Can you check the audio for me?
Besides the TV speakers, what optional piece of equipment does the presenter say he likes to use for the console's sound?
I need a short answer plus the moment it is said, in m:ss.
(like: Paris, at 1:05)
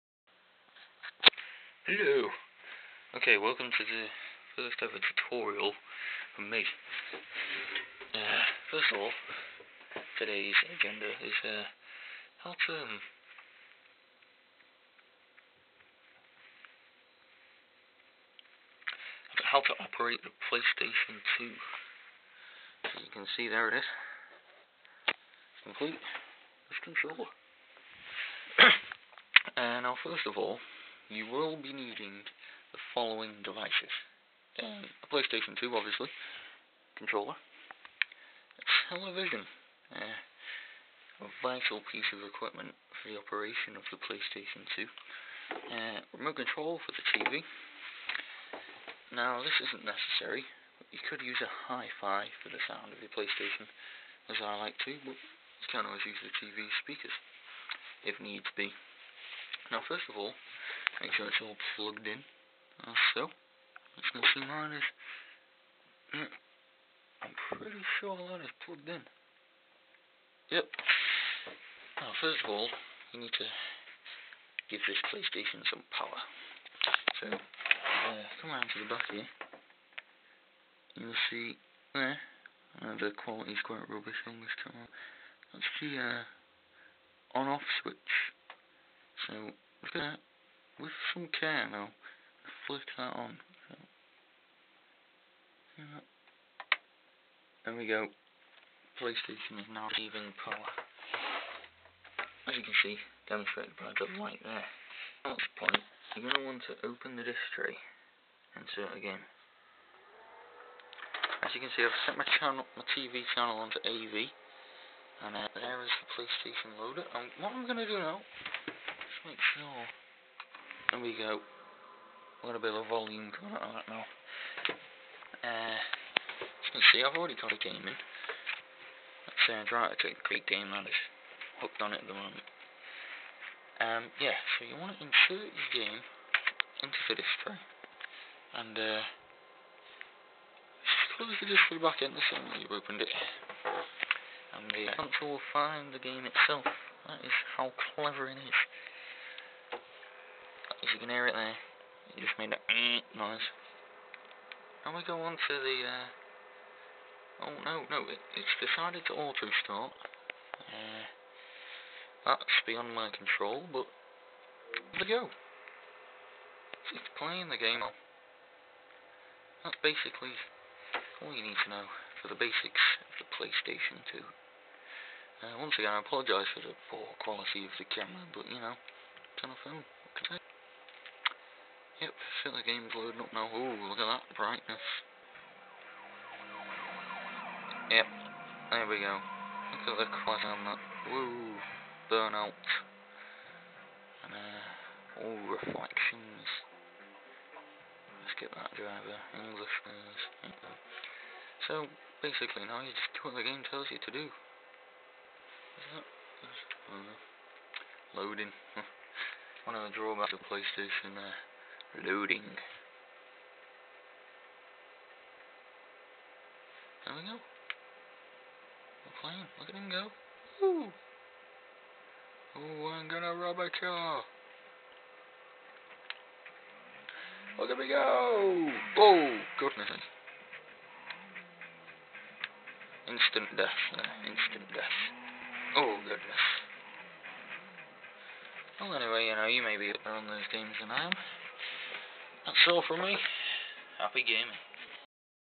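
Hi-fi, at 0:51.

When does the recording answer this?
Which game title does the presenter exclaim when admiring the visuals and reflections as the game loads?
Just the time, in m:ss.
3:12.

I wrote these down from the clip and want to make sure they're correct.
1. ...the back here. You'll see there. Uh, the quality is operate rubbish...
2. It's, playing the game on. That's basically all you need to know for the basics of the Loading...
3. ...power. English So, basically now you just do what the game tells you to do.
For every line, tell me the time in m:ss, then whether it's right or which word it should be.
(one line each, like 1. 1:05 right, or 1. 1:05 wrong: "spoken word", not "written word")
1. 1:18 wrong: "quite", not "operate"
2. 2:46 wrong: "PlayStation", not "Loading"
3. 3:18 wrong: "driver", not "power".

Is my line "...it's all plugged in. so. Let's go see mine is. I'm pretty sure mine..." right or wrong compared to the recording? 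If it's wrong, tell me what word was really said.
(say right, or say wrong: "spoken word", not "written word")
right.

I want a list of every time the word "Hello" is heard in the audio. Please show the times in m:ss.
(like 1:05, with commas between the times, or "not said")
0:01.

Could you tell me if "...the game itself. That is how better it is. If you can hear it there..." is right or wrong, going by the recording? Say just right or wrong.
wrong.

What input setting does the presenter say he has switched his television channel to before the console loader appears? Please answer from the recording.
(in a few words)
AV.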